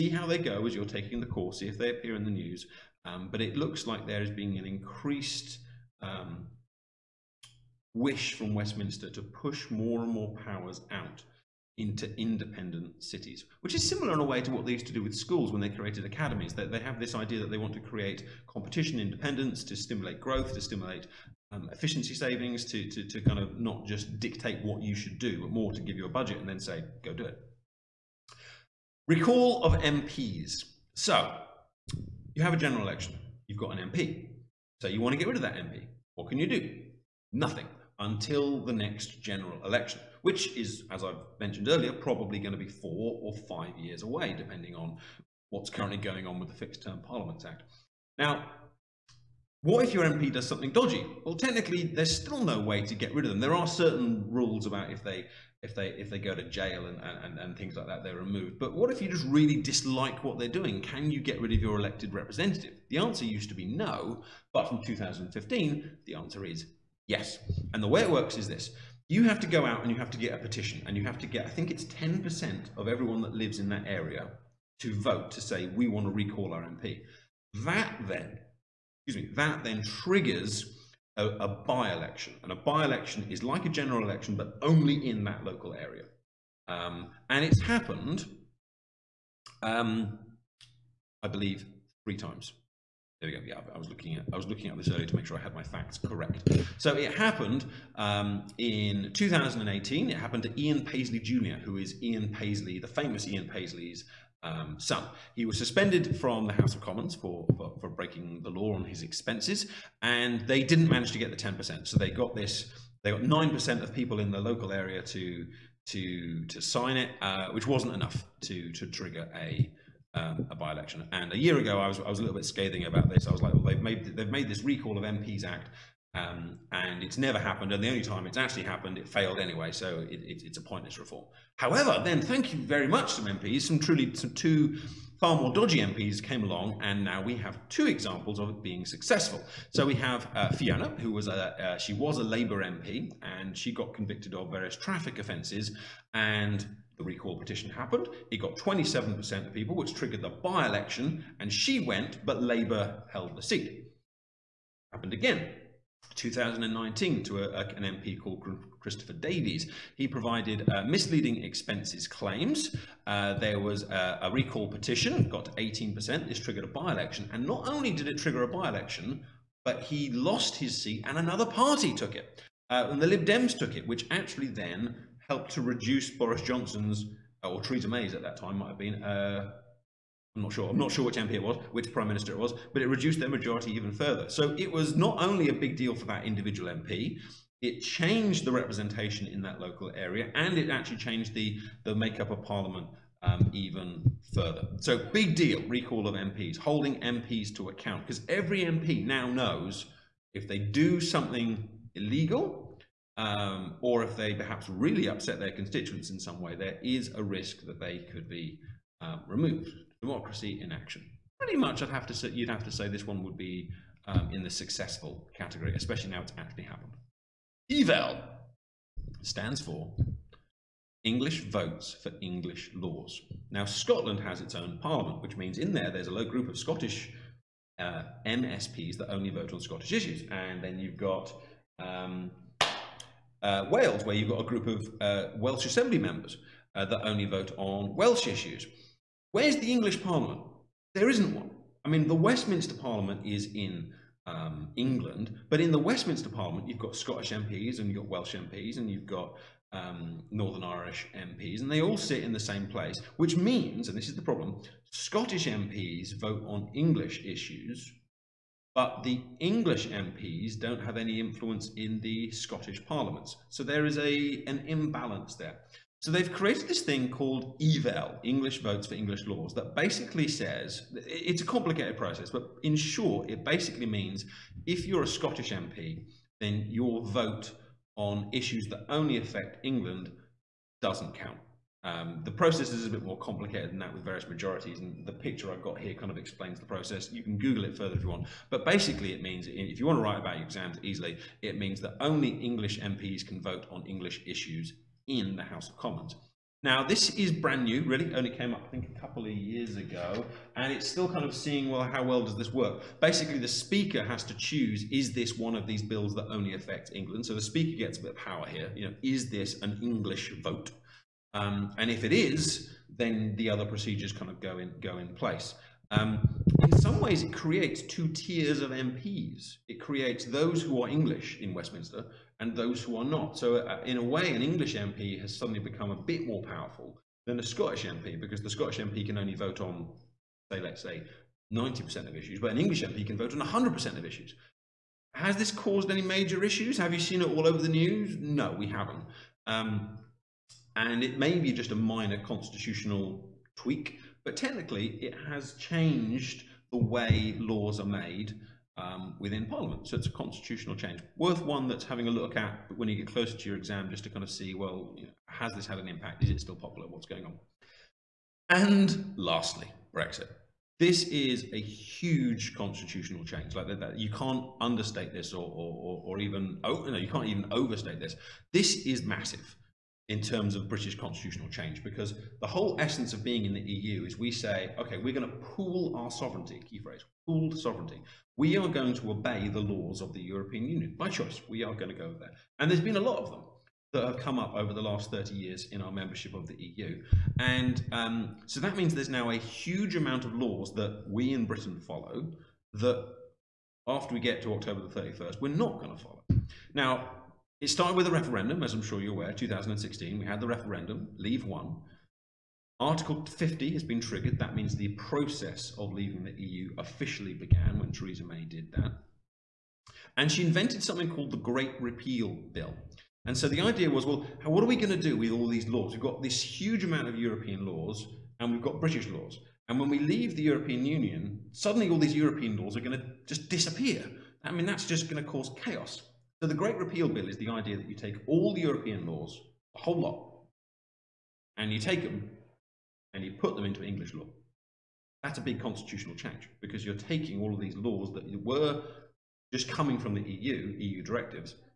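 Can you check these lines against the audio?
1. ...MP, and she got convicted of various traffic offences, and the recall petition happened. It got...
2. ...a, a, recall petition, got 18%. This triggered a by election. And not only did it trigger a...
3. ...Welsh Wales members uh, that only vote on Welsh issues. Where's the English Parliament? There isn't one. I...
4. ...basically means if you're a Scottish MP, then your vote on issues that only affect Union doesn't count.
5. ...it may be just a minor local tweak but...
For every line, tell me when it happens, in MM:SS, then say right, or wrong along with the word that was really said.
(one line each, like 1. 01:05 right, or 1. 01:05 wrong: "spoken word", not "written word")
1. 02:22 right
2. 02:43 right
3. 03:55 wrong: "Assembly", not "Wales"
4. 04:33 wrong: "England", not "Union"
5. 05:41 wrong: "constitutional", not "local".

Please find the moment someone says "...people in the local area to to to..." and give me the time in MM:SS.
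01:53.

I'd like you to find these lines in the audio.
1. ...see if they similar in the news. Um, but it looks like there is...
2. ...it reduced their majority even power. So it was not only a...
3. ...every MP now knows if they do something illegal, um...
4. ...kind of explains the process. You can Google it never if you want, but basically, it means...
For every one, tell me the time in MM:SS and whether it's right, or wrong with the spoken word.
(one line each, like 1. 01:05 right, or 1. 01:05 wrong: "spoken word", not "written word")
1. 00:01 wrong: "appear", not "similar"
2. 03:02 wrong: "further", not "power"
3. 03:18 right
4. 04:45 wrong: "further", not "never".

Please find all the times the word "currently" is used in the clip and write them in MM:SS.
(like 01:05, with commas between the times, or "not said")
00:45.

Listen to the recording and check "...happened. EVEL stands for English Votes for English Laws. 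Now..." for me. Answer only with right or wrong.
right.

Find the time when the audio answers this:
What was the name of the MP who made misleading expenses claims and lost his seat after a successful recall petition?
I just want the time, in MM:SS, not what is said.
02:38.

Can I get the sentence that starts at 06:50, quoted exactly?
And she invented something called the Great Repeal Bill.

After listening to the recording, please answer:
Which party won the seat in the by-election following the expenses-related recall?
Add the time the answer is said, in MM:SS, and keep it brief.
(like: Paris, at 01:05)
Lib Dems, at 02:53.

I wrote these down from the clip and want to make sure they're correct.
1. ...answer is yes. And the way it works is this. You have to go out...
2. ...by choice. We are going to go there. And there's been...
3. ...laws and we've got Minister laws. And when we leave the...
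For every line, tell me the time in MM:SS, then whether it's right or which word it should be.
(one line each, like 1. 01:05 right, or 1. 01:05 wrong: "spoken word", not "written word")
1. 01:06 right
2. 06:20 right
3. 06:57 wrong: "British", not "Minister".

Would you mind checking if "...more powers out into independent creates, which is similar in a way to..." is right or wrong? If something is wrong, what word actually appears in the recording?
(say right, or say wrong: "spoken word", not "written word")
wrong: "cities", not "creates".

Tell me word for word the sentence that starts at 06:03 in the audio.
Like that, you can't understate this, or, or, or even oh, no, you can't even overstate this.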